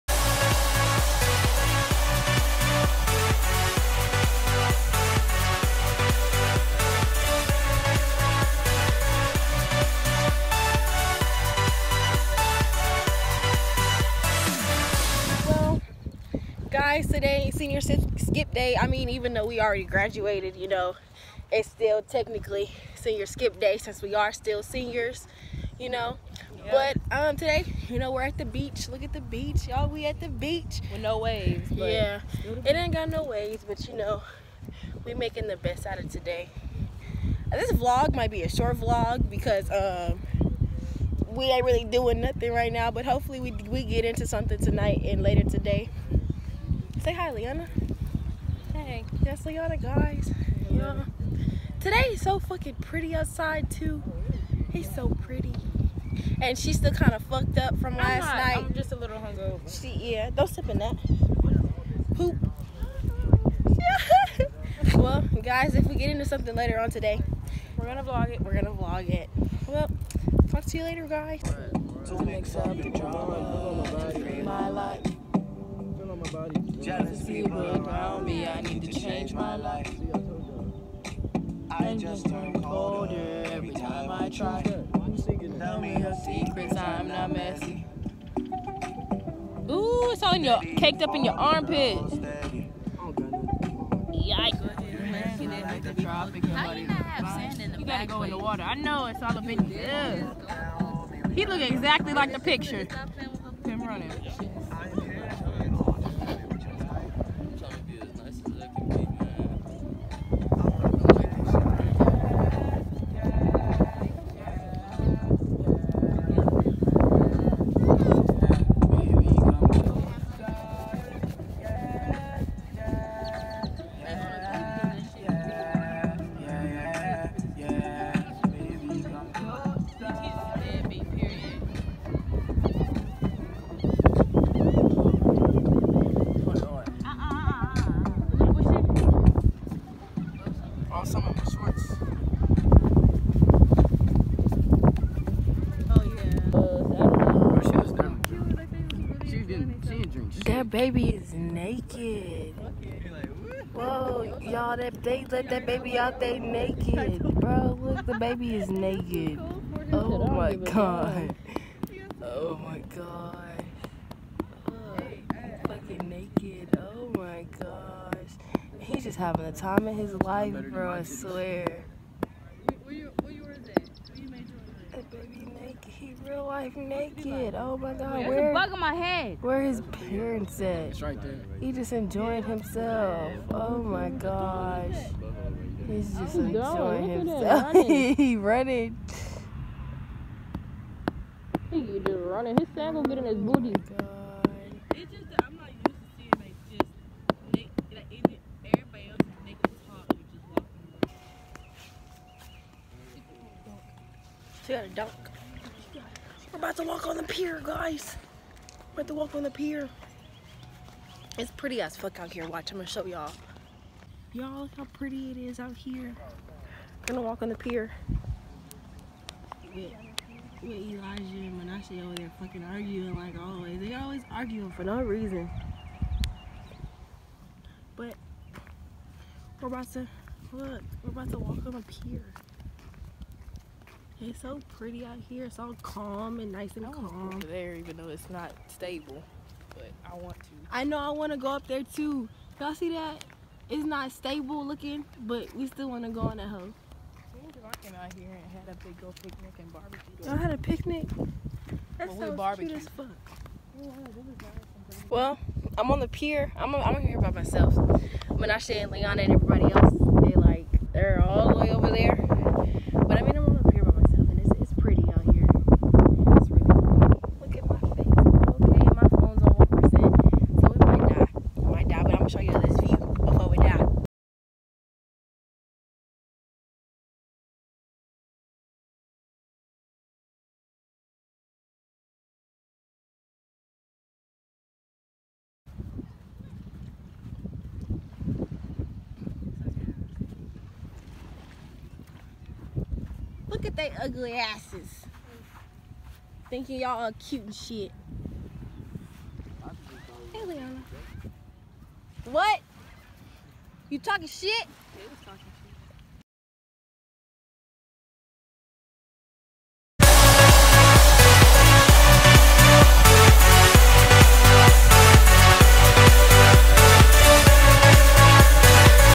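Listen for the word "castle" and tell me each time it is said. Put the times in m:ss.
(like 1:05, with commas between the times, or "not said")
not said.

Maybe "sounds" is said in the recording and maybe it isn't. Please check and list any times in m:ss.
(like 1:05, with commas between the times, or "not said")
4:12.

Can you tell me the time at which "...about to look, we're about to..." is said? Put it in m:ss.
3:49.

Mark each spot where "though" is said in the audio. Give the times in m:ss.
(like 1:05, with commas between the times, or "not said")
0:19, 3:57.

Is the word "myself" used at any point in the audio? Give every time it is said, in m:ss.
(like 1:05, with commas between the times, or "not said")
4:17.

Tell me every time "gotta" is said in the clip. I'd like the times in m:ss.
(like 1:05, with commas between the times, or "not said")
1:37.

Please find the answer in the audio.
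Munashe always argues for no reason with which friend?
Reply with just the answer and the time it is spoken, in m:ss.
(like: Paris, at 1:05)
Elijah, at 3:40.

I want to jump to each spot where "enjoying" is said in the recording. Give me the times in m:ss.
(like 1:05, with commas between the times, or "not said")
3:01, 3:06.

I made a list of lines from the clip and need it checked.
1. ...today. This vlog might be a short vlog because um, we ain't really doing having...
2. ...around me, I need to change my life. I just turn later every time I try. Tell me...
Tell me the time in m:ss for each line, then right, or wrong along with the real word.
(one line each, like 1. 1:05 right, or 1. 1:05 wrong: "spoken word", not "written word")
1. 0:36 wrong: "nothing", not "having"
2. 1:17 wrong: "colder", not "later".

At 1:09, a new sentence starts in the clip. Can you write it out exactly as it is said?
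Well, talk to you later, guys.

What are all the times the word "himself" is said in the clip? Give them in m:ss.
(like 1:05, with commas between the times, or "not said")
3:02, 3:07.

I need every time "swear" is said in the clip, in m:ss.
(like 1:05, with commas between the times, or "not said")
2:51.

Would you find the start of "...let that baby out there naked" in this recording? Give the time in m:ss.
2:35.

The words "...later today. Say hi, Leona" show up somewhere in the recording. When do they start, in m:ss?
0:45.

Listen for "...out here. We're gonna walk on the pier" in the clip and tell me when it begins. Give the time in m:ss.
3:35.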